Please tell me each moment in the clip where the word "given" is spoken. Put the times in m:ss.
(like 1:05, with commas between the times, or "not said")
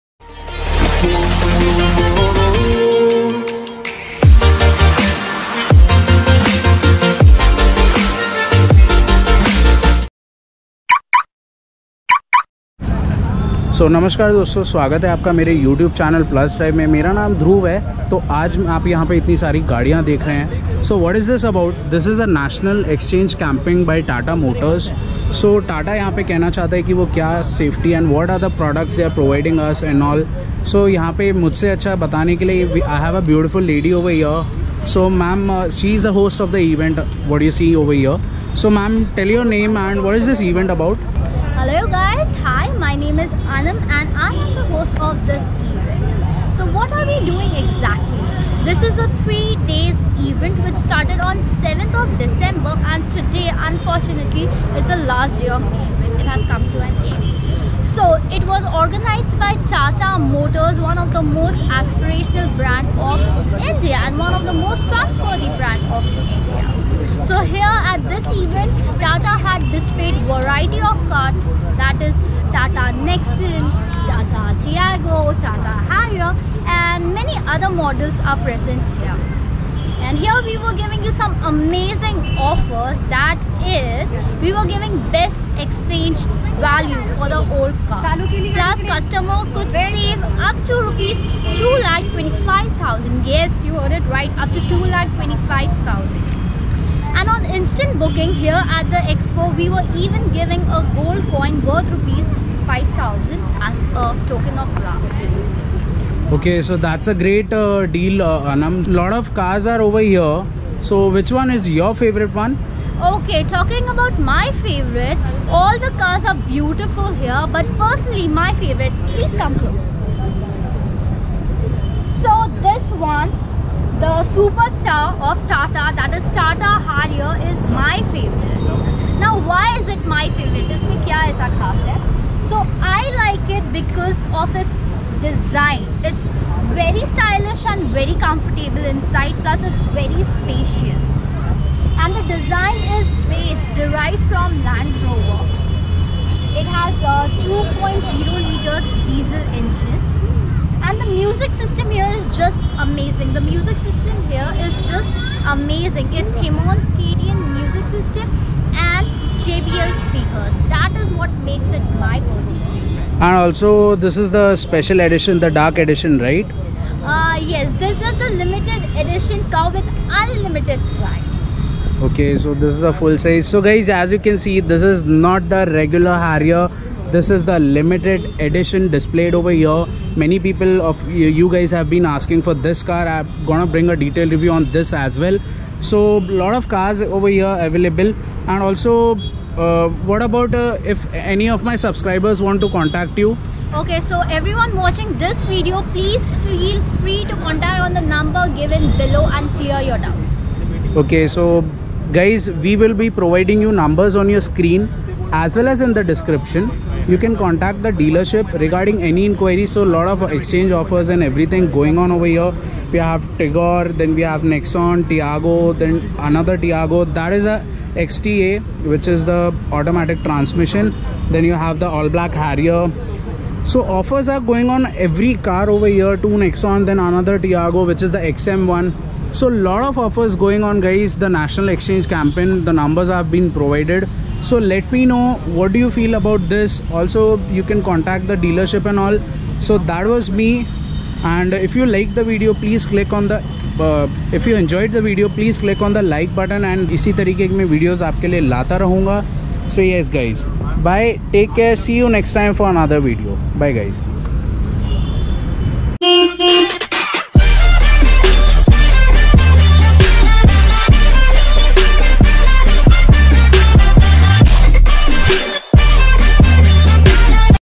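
3:18.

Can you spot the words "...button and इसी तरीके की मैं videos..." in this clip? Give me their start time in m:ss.
4:06.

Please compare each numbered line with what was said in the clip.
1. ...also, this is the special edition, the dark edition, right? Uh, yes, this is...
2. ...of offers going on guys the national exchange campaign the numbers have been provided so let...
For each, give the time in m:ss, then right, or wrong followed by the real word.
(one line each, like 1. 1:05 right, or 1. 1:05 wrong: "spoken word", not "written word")
1. 2:43 right
2. 3:49 right.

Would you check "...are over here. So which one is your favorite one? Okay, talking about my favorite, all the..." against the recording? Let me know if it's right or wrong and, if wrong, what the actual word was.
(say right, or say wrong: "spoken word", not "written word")
right.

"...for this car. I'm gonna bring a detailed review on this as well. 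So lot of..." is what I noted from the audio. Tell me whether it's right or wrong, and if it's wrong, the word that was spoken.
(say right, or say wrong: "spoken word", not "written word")
right.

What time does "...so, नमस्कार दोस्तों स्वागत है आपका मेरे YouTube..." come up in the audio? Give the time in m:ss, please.
0:13.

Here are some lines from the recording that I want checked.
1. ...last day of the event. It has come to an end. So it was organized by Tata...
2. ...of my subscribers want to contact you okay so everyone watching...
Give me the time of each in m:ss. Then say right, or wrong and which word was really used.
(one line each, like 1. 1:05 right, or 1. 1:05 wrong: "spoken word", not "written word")
1. 0:54 right
2. 3:11 right.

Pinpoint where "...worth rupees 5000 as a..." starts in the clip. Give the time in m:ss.
1:41.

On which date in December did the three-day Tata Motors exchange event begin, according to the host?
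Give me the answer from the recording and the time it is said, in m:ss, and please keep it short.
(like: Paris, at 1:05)
7th December, at 0:51.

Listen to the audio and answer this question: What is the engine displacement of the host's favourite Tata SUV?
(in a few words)
2.0 liters.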